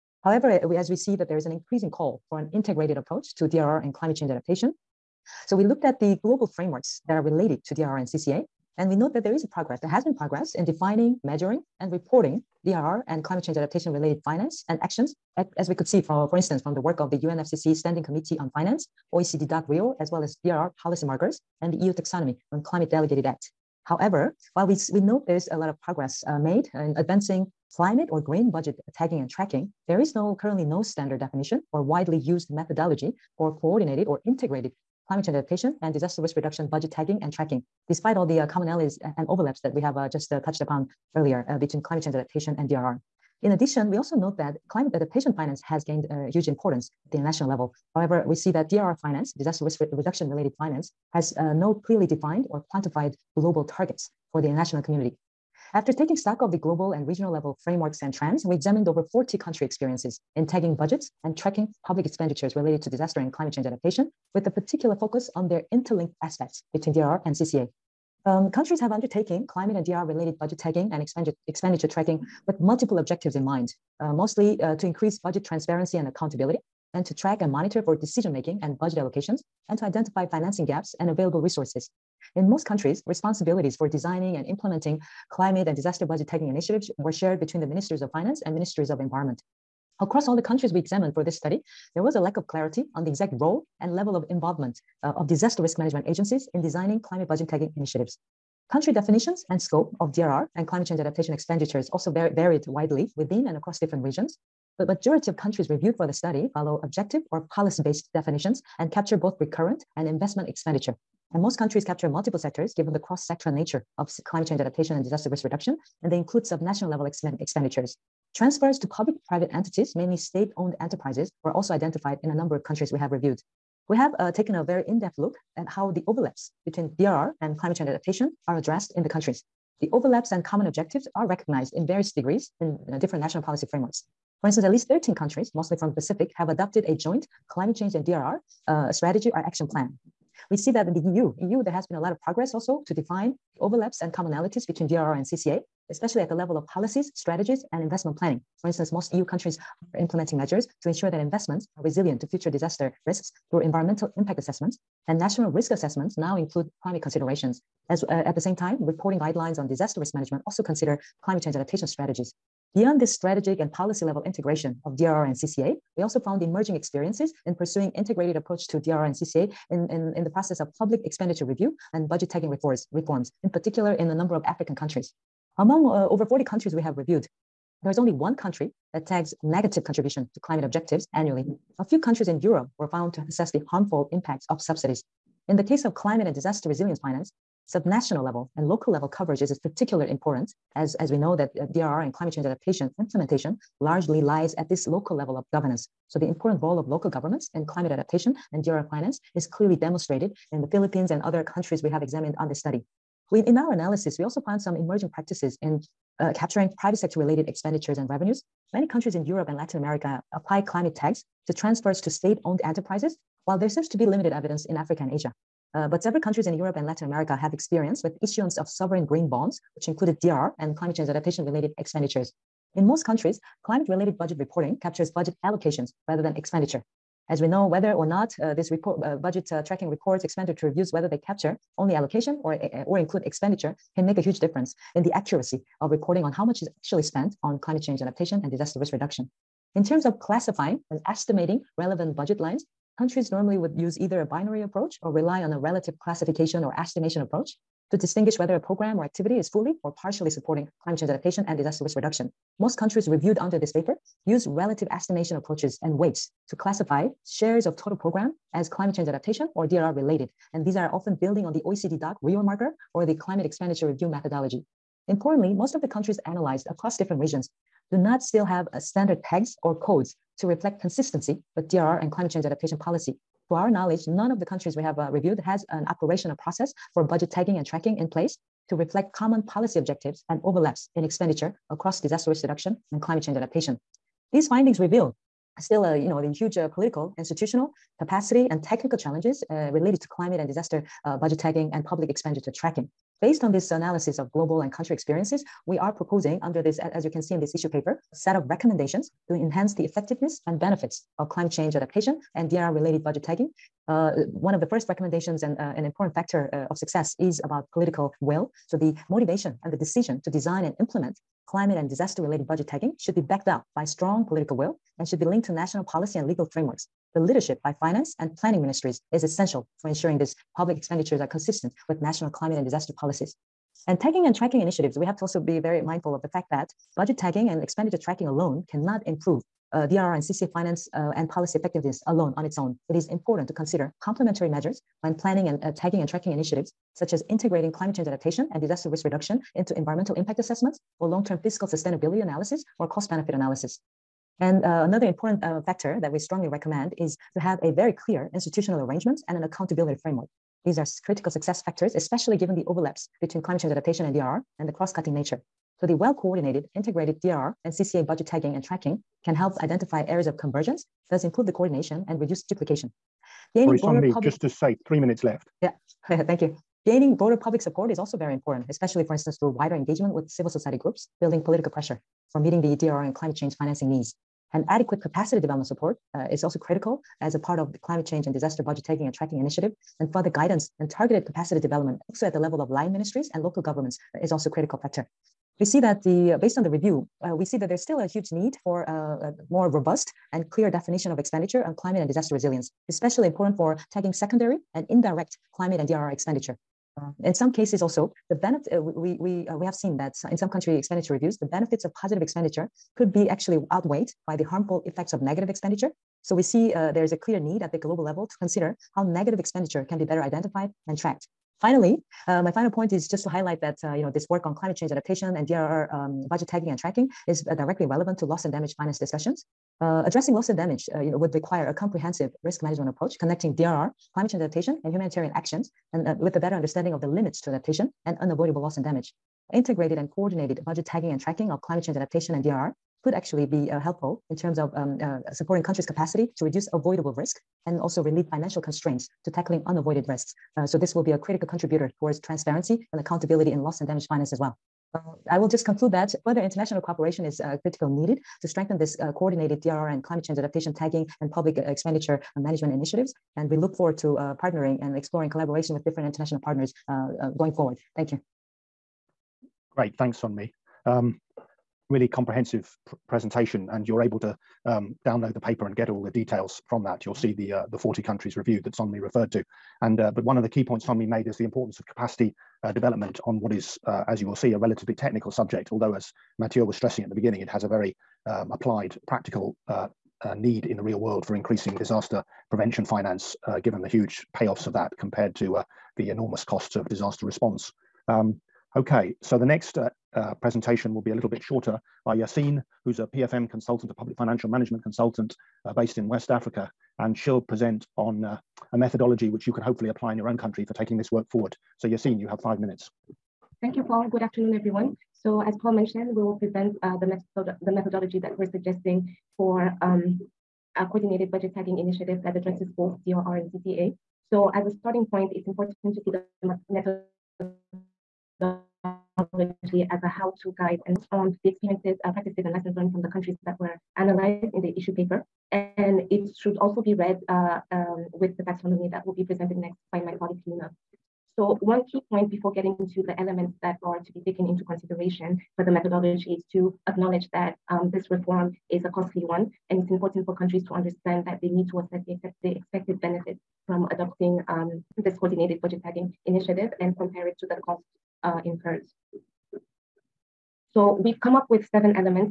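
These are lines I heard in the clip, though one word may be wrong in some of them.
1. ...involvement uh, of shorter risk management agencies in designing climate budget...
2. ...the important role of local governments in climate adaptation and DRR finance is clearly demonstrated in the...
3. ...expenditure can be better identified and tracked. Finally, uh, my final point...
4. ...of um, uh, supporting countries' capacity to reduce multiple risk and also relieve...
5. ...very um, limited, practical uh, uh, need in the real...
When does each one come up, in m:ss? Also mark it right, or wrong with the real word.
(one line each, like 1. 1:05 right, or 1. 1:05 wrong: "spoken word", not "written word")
1. 1:34 wrong: "disaster", not "shorter"
2. 3:16 right
3. 6:49 right
4. 7:14 wrong: "avoidable", not "multiple"
5. 7:57 wrong: "applied", not "limited".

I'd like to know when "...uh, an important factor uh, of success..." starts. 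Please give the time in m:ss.
5:05.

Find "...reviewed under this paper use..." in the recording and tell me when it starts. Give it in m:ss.
4:13.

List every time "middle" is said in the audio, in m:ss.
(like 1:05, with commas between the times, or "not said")
not said.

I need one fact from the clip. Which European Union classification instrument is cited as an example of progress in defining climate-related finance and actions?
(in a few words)
EU taxonomy on Climate Delegated Act.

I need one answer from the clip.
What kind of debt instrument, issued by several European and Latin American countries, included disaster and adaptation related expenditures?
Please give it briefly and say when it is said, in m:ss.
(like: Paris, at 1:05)
sovereign green bonds, at 3:38.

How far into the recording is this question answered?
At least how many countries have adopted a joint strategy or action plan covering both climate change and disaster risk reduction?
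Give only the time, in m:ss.
2:14.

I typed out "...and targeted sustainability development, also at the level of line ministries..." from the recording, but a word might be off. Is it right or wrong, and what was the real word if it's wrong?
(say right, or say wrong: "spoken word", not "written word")
wrong: "capacity", not "sustainability".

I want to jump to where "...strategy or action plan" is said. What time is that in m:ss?
2:18.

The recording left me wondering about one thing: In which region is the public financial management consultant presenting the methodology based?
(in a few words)
West Africa.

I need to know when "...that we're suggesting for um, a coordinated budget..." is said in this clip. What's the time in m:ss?
8:28.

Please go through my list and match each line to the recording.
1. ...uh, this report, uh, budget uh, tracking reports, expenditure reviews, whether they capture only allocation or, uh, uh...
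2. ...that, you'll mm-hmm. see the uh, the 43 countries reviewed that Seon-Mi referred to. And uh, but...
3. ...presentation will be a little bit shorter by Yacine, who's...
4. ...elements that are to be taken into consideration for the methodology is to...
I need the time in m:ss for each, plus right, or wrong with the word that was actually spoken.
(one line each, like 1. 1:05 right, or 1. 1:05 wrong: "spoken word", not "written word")
1. 3:48 right
2. 7:46 wrong: "40", not "43"
3. 8:10 right
4. 8:53 right.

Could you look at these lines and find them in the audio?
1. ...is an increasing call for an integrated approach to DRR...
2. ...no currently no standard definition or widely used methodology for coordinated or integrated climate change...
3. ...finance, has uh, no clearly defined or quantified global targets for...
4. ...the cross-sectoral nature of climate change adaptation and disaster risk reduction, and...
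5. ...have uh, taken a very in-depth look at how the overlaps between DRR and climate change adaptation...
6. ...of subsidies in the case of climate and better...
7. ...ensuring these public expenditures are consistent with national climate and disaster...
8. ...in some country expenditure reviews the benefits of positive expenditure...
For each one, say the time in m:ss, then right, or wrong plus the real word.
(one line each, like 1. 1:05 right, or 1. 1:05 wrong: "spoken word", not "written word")
1. 0:01 right
2. 0:30 right
3. 0:50 right
4. 1:52 right
5. 2:03 right
6. 3:04 wrong: "disaster", not "better"
7. 5:19 right
8. 6:40 right.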